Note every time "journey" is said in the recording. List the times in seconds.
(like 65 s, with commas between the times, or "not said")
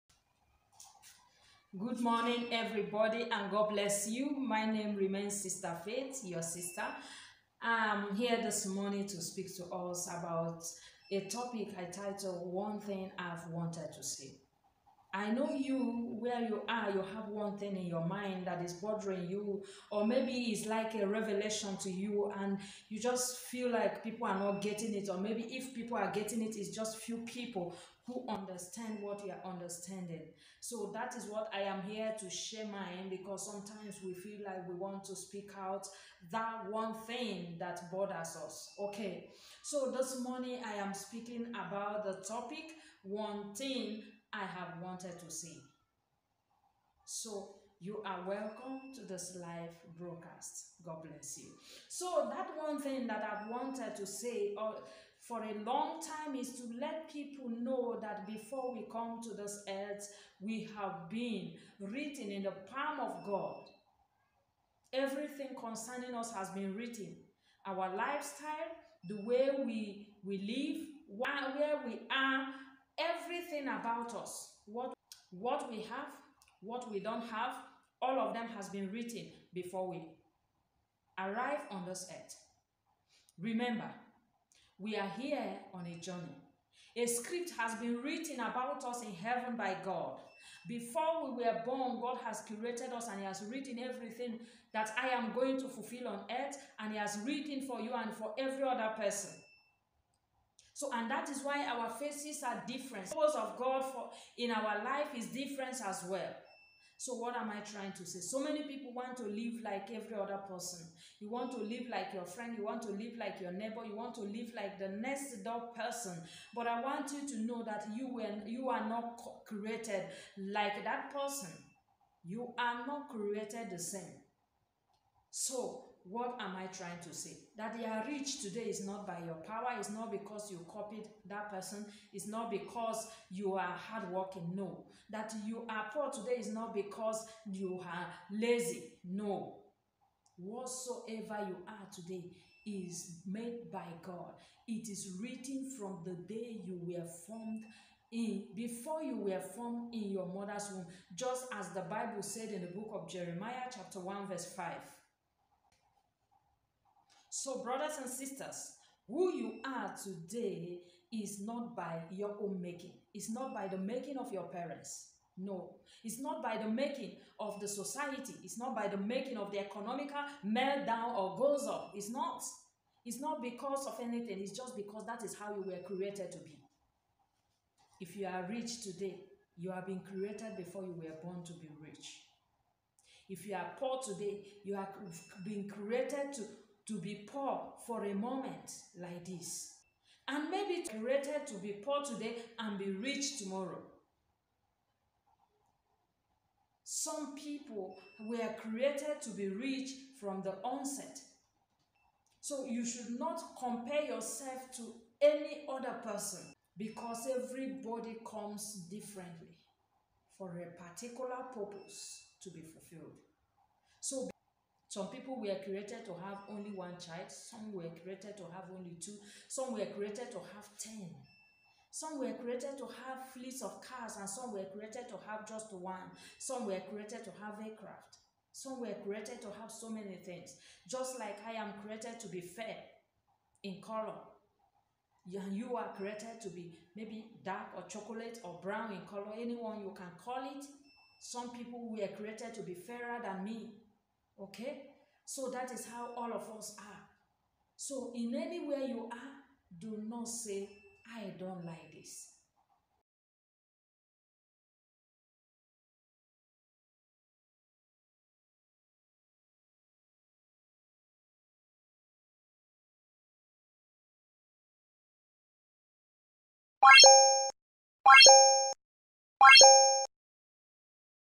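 85 s.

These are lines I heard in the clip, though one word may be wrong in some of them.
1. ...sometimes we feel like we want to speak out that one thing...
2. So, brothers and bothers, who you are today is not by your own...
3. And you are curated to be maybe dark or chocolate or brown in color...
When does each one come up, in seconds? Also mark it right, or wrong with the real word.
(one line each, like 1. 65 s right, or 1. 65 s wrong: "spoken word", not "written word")
1. 33 s right
2. 157 s wrong: "sisters", not "bothers"
3. 235 s wrong: "created", not "curated".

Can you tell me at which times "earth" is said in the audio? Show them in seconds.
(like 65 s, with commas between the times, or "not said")
59 s, 82 s, 96 s.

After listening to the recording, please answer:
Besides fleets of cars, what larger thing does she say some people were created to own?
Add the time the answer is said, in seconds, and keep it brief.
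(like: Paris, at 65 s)
aircraft, at 227 s.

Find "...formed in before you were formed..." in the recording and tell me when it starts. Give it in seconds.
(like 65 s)
147 s.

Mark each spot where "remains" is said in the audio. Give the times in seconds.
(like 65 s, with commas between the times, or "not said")
4 s.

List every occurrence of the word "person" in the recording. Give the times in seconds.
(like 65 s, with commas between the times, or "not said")
98 s, 110 s, 115 s, 121 s, 131 s, 206 s.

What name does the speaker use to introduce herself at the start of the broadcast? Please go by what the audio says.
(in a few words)
Sister Faith.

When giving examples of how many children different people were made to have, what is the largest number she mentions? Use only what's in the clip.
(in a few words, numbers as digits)
10.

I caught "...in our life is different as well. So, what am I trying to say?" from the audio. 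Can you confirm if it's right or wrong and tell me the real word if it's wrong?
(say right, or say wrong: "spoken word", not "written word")
right.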